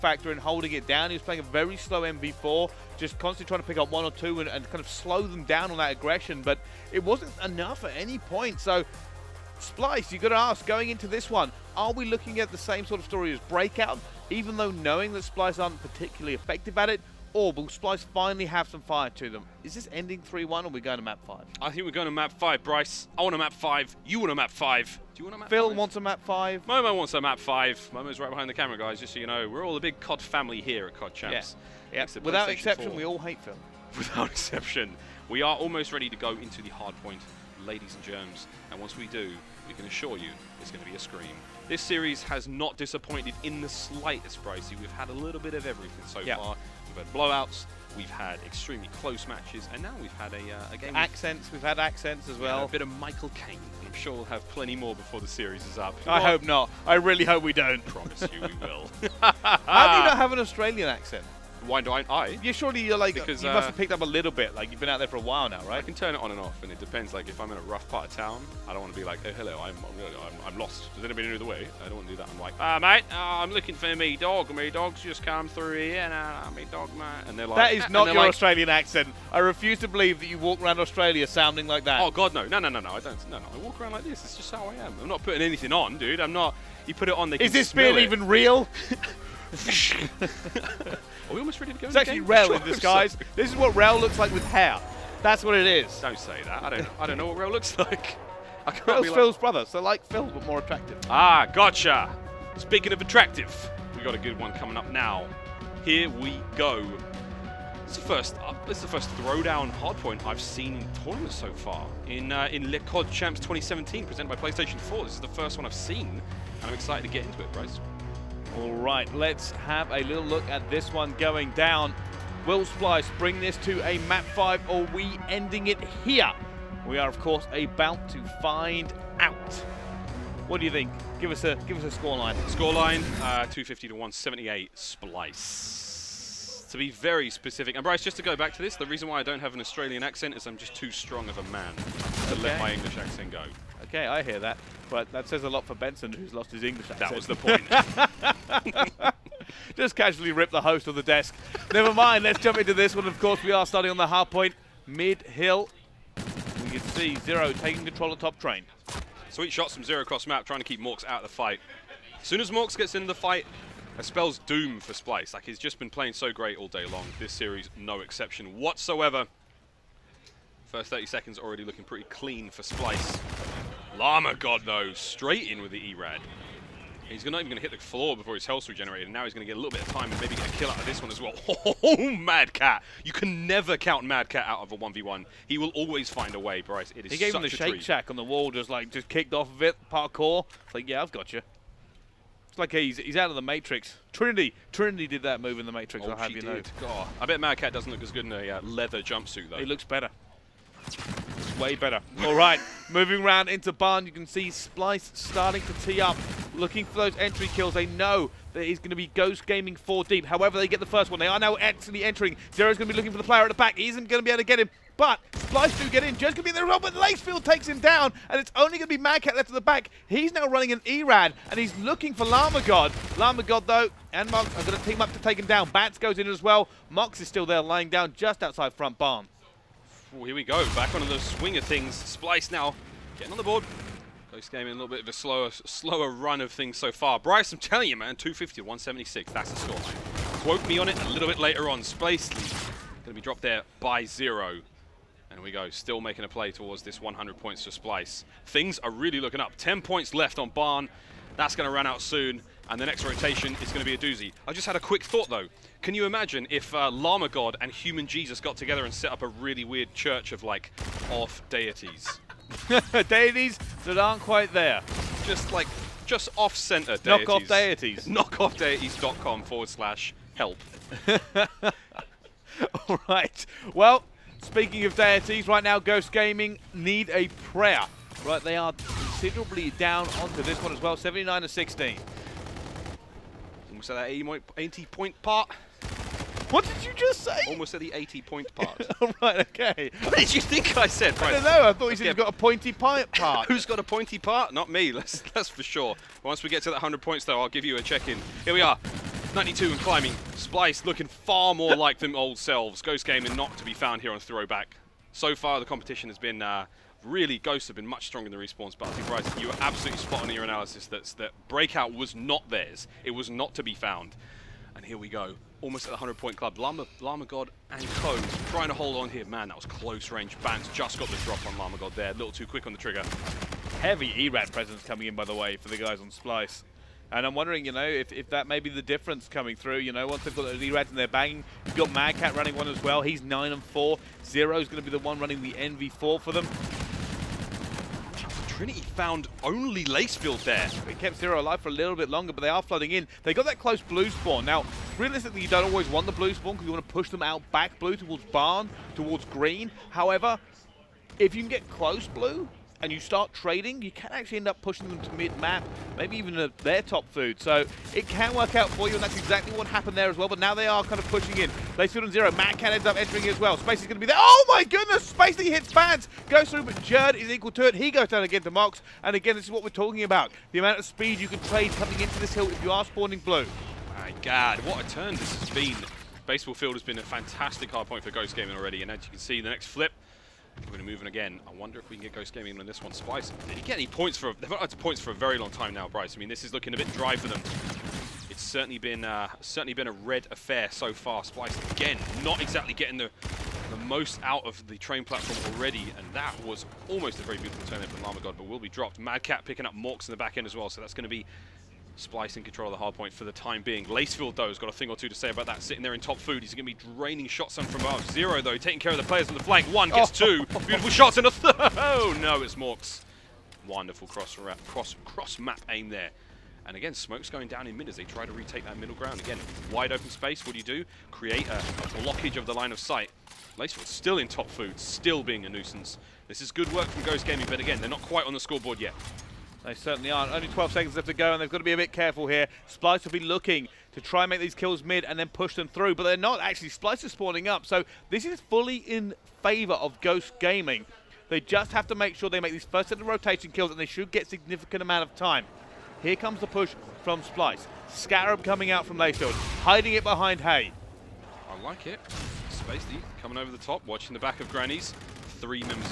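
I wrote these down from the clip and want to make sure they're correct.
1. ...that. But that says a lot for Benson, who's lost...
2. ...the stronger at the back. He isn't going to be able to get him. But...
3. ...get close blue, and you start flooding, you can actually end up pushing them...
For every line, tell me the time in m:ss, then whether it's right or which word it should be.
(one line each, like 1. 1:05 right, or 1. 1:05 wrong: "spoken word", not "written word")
1. 2:24 right
2. 3:33 wrong: "player", not "stronger"
3. 5:51 wrong: "trading", not "flooding".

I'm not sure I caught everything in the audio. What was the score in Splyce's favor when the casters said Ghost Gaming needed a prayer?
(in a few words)
79 to 16.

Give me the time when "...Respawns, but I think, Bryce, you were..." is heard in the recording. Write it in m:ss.
5:08.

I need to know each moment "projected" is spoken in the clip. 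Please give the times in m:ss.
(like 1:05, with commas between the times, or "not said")
not said.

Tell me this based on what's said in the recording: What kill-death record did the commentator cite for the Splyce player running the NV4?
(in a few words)
9 and 4.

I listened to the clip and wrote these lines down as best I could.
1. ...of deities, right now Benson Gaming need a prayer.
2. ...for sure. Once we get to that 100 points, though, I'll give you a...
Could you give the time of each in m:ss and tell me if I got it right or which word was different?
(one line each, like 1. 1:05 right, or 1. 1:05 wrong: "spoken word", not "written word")
1. 4:34 wrong: "Ghost", not "Benson"
2. 4:55 right.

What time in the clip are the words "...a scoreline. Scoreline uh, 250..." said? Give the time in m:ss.
2:11.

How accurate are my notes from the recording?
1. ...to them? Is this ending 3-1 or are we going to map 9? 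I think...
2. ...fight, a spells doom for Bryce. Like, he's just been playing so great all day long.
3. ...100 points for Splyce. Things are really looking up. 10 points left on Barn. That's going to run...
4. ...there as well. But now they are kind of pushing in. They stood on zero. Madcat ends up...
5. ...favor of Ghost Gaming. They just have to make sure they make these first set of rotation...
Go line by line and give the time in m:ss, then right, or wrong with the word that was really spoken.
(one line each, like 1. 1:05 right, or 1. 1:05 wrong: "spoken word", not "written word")
1. 0:19 wrong: "5", not "9"
2. 2:43 wrong: "Splyce", not "Bryce"
3. 4:07 right
4. 5:59 right
5. 7:19 right.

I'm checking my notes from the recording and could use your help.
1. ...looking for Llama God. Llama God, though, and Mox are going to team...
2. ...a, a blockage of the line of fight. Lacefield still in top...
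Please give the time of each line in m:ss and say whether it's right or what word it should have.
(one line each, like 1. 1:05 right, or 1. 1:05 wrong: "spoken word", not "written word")
1. 3:41 right
2. 7:01 wrong: "sight", not "fight".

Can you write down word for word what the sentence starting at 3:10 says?
It's like, yeah, I've got you.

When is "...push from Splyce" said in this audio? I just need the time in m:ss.
7:26.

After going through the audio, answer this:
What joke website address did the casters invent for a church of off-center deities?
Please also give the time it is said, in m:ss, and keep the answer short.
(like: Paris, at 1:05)
Knockoffdeities.com, at 4:28.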